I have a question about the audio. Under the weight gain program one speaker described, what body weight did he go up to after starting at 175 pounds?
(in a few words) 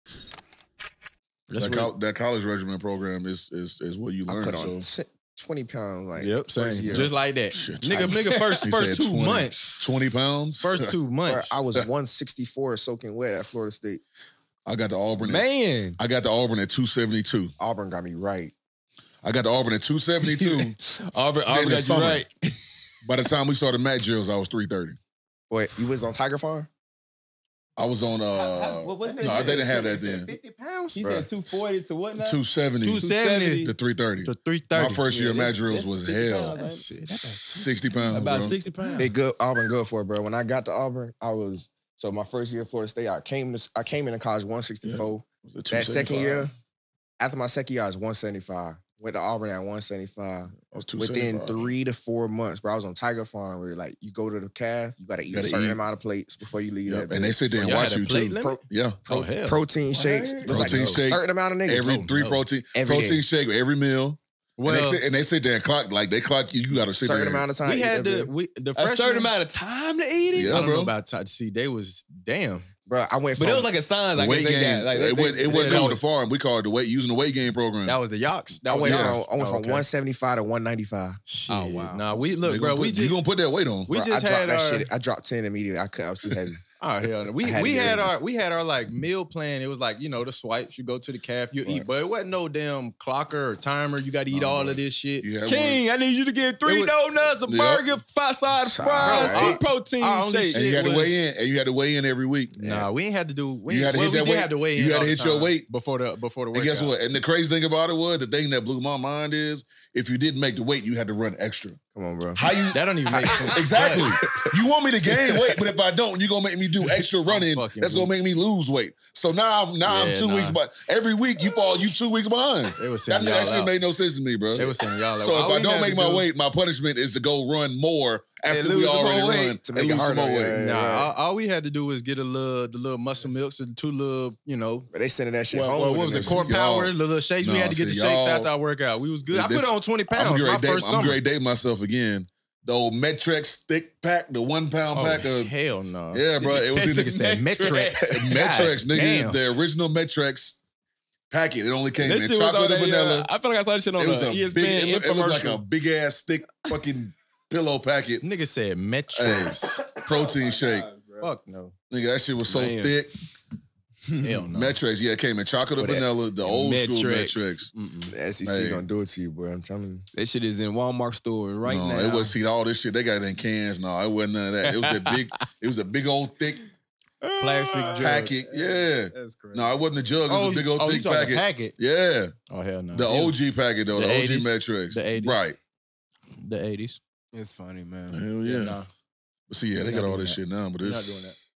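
195 pounds.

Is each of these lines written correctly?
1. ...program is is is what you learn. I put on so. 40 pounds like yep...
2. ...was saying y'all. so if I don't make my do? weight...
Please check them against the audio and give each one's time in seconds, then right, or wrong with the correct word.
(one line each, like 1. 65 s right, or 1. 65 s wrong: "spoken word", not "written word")
1. 2 s wrong: "20", not "40"
2. 124 s right.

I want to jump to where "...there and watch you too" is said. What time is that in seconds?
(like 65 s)
57 s.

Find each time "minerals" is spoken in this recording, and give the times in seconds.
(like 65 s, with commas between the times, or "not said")
not said.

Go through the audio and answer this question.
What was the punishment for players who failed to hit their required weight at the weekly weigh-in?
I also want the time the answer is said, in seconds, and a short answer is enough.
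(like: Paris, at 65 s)
Run extra, at 111 s.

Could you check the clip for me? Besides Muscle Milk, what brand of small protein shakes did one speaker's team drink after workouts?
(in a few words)
Core Power.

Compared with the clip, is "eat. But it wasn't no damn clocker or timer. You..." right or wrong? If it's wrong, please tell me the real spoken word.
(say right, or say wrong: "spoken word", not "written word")
right.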